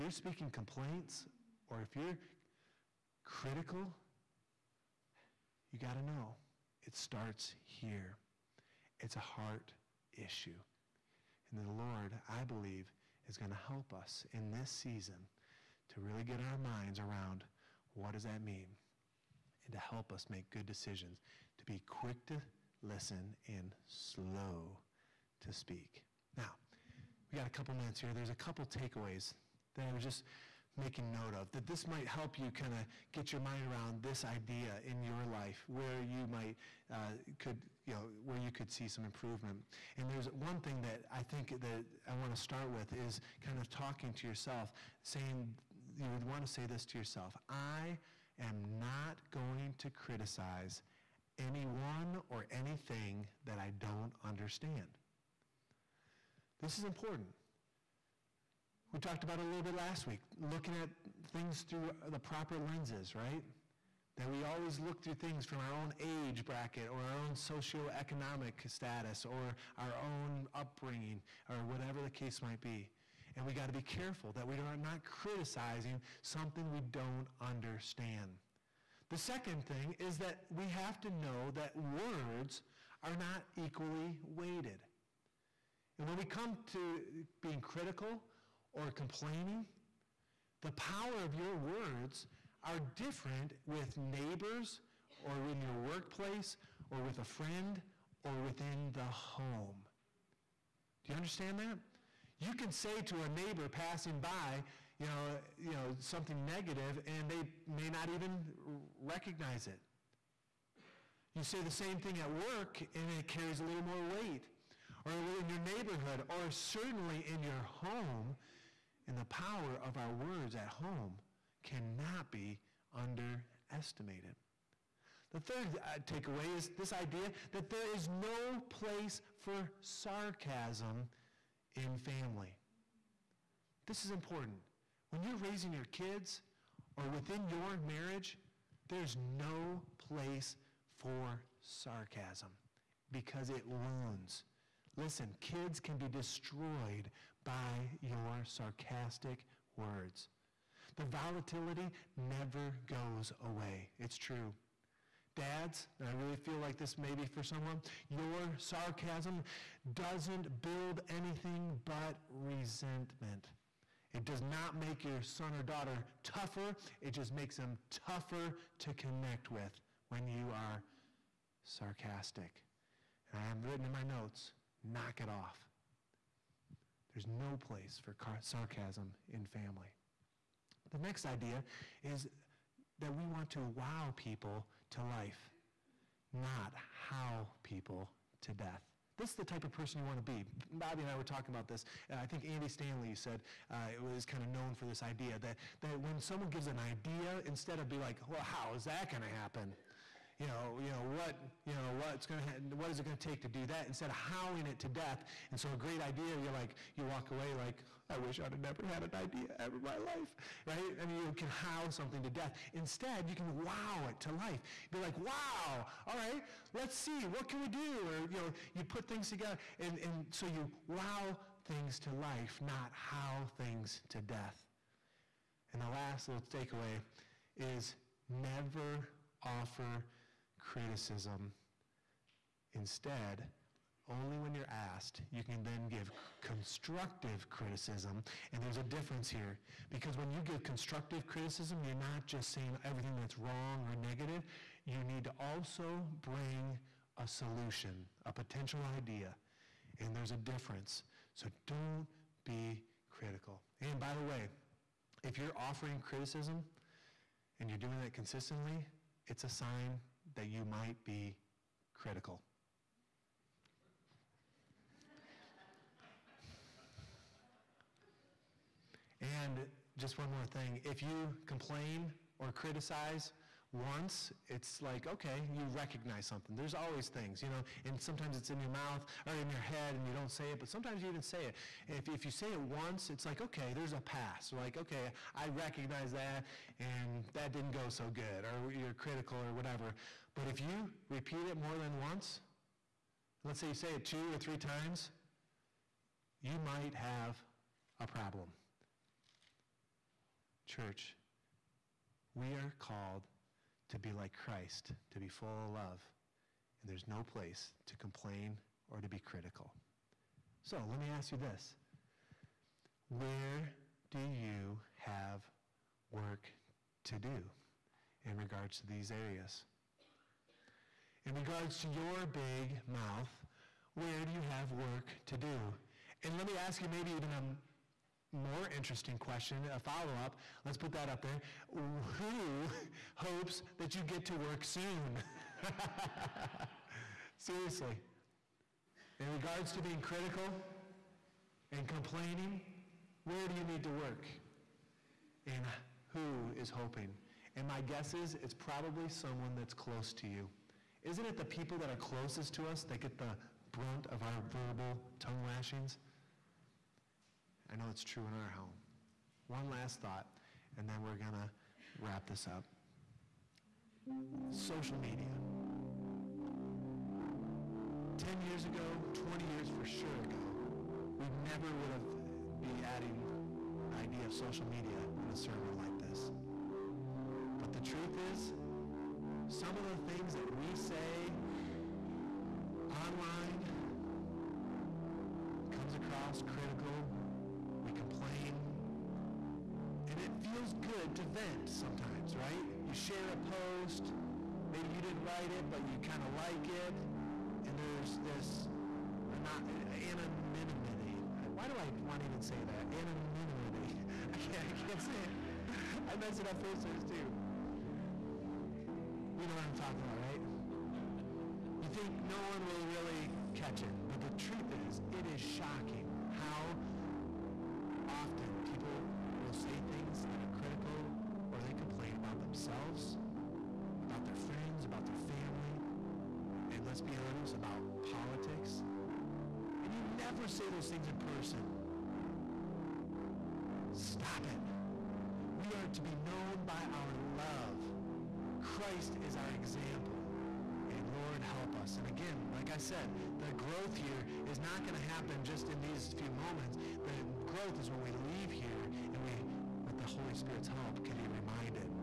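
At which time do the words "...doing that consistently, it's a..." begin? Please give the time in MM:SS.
04:17.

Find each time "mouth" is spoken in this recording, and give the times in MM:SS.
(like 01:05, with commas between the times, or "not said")
04:38, 05:22.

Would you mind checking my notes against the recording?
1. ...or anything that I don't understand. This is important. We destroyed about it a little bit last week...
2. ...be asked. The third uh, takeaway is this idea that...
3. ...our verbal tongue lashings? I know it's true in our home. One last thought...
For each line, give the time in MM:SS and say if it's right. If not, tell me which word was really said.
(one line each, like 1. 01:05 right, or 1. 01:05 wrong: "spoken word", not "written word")
1. 00:52 wrong: "talked", not "destroyed"
2. 02:02 wrong: "underestimated", not "asked"
3. 05:54 right.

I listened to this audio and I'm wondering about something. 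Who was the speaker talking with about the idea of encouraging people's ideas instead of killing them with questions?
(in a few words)
Bobby.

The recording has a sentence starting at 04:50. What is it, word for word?
But if you repeat it more than once, let's say you say it two or three times, you might have a problem.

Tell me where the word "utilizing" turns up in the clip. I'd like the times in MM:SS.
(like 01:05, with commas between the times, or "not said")
not said.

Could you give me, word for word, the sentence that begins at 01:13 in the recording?
And we got to be careful that we are not criticizing something we don't understand.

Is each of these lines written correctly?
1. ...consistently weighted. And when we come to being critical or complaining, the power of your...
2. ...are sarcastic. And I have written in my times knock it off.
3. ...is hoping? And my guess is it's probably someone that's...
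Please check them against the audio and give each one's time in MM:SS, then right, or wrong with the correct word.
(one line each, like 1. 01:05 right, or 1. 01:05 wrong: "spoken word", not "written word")
1. 01:23 wrong: "equally", not "consistently"
2. 02:50 wrong: "notes", not "times"
3. 05:46 right.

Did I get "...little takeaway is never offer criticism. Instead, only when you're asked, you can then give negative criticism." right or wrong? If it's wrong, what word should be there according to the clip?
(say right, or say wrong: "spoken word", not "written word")
wrong: "constructive", not "negative".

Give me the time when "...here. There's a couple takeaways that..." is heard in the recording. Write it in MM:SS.
00:27.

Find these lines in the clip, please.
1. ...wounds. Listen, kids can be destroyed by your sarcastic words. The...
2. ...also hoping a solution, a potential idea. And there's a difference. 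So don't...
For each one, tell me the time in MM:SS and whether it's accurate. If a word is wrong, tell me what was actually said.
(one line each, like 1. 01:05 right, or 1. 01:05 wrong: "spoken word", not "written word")
1. 02:23 right
2. 04:05 wrong: "bring", not "hoping".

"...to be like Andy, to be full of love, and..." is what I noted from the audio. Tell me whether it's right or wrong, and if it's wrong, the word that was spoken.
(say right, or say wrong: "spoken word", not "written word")
wrong: "Christ", not "Andy".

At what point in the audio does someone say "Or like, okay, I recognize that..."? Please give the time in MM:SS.
04:44.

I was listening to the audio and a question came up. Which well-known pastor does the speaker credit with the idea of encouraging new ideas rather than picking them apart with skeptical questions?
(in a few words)
Andy Stanley.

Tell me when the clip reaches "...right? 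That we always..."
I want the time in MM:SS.
01:03.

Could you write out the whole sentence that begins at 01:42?
You can say to a neighbor passing by, you know, you know, something negative, and they may not even recognize it.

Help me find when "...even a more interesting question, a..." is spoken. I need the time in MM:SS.
05:27.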